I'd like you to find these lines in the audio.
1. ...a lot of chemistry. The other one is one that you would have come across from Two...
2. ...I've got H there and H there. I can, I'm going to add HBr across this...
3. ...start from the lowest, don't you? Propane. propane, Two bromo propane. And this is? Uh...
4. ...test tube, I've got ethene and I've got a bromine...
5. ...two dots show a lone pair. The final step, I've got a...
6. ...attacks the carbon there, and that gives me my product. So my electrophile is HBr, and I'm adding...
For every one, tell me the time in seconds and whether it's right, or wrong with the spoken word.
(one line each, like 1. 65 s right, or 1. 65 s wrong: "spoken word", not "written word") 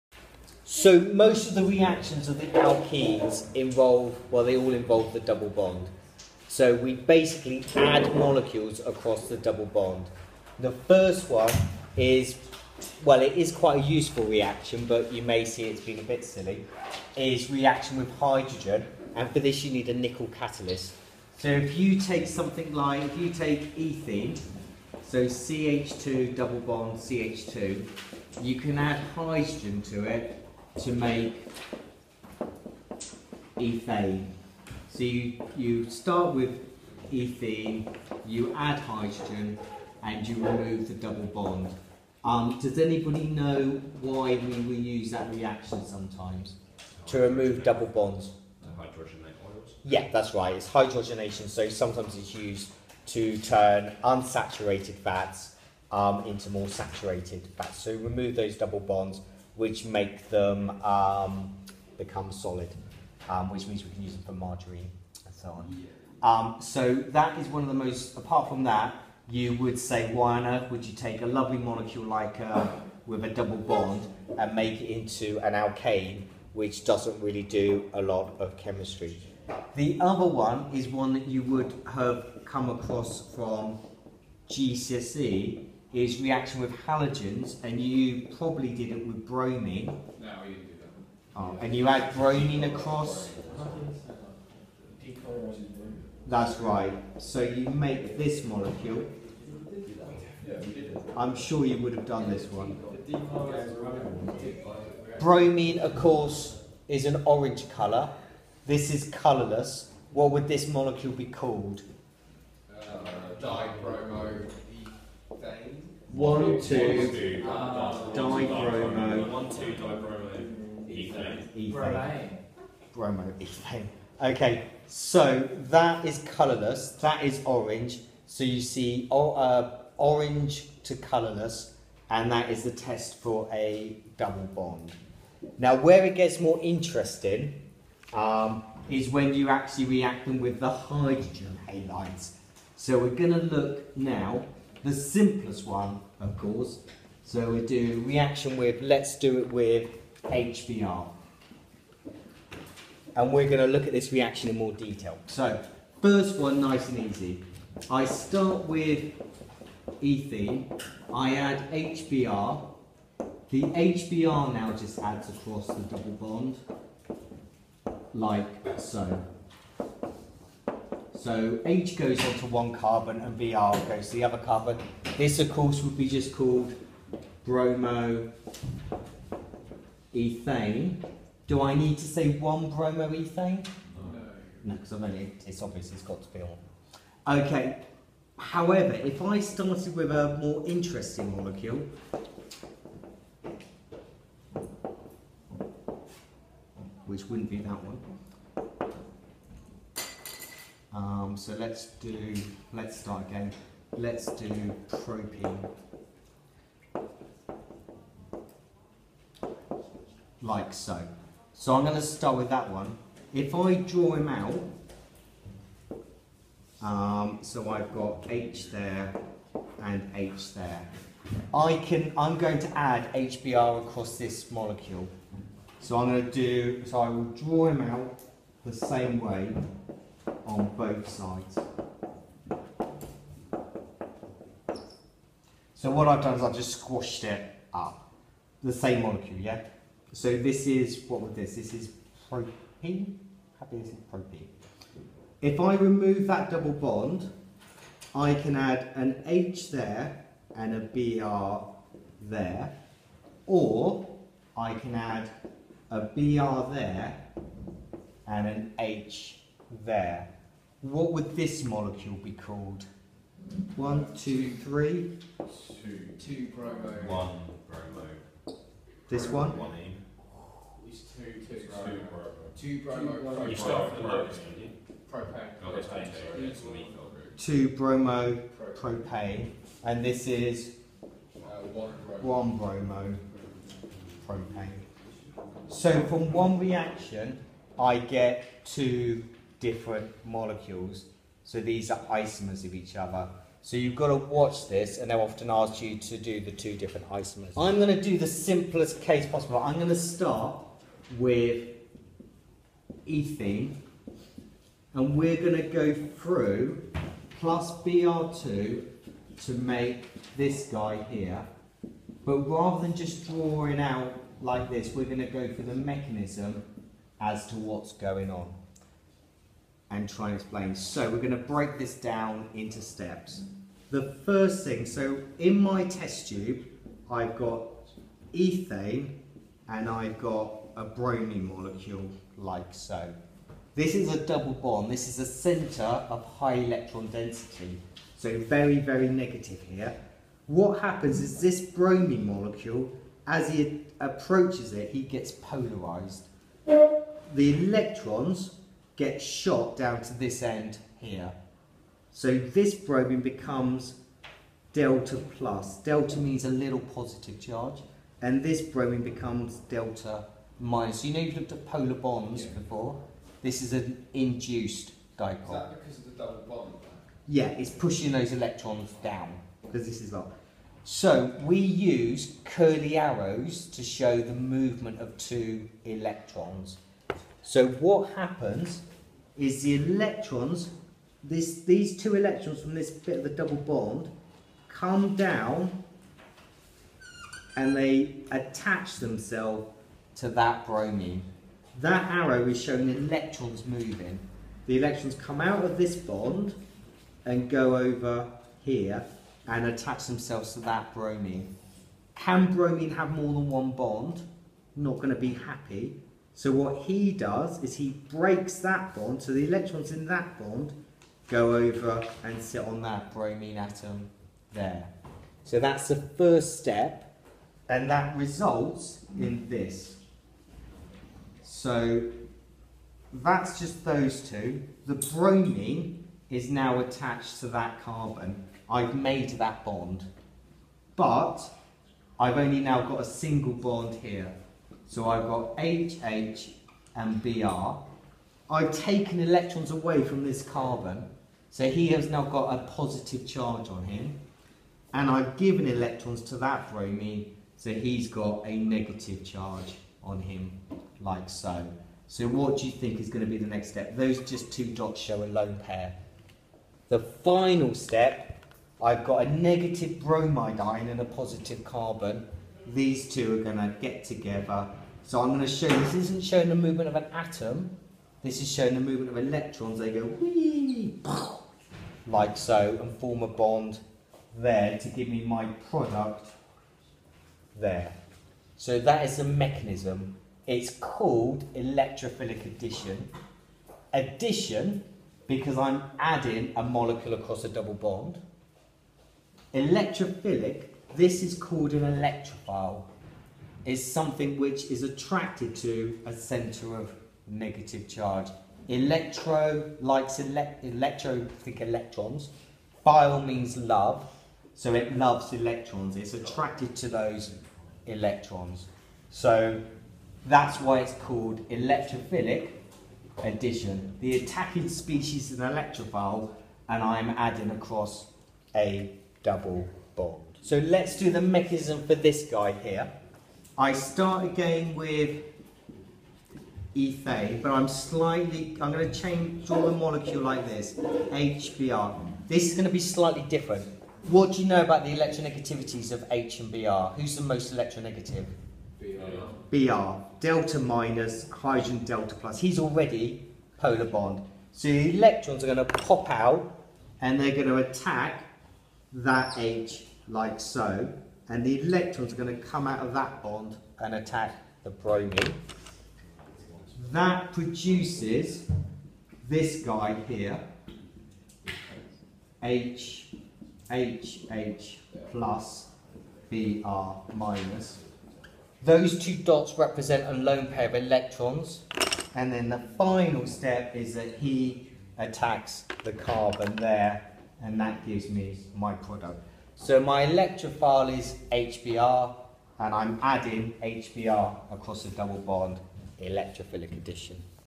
1. 77 s wrong: "GCSE", not "Two"
2. 217 s right
3. 273 s right
4. 325 s right
5. 454 s right
6. 574 s right.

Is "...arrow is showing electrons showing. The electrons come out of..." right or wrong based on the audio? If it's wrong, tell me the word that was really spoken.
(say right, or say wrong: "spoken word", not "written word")
wrong: "moving", not "showing".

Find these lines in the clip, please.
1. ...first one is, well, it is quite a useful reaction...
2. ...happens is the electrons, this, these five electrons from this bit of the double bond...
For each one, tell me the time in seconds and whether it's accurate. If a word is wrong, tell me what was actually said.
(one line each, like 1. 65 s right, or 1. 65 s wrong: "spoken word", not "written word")
1. 10 s right
2. 378 s wrong: "two", not "five".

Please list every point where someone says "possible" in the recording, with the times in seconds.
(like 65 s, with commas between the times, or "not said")
299 s.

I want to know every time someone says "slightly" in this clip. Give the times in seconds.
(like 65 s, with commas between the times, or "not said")
527 s, 532 s.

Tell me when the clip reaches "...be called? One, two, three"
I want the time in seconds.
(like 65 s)
262 s.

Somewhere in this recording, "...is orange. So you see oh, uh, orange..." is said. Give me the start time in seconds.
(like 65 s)
127 s.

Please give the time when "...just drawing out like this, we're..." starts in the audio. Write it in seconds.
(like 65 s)
312 s.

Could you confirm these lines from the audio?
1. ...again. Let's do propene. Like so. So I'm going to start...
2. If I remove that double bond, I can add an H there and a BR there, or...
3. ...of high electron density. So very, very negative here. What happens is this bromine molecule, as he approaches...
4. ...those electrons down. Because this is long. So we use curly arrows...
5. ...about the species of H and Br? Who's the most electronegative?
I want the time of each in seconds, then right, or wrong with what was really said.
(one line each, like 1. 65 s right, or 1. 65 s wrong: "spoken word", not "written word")
1. 203 s right
2. 245 s right
3. 335 s right
4. 368 s right
5. 534 s wrong: "electronegativities", not "species".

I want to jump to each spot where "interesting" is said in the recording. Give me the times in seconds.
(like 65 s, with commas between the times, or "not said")
136 s, 190 s.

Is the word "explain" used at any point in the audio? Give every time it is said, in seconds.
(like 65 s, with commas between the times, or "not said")
320 s.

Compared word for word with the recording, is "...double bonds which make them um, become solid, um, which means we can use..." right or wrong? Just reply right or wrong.
right.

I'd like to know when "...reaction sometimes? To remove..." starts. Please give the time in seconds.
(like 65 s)
45 s.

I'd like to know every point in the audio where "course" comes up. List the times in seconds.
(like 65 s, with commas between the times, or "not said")
105 s, 146 s, 175 s.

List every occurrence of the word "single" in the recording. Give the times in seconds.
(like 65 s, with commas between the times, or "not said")
433 s.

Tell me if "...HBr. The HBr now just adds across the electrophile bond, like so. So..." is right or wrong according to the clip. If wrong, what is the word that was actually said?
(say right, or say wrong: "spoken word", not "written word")
wrong: "double", not "electrophile".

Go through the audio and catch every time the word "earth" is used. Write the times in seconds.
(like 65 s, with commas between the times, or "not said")
70 s.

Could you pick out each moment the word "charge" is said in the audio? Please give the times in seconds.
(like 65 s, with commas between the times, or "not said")
357 s, 443 s, 449 s, 497 s.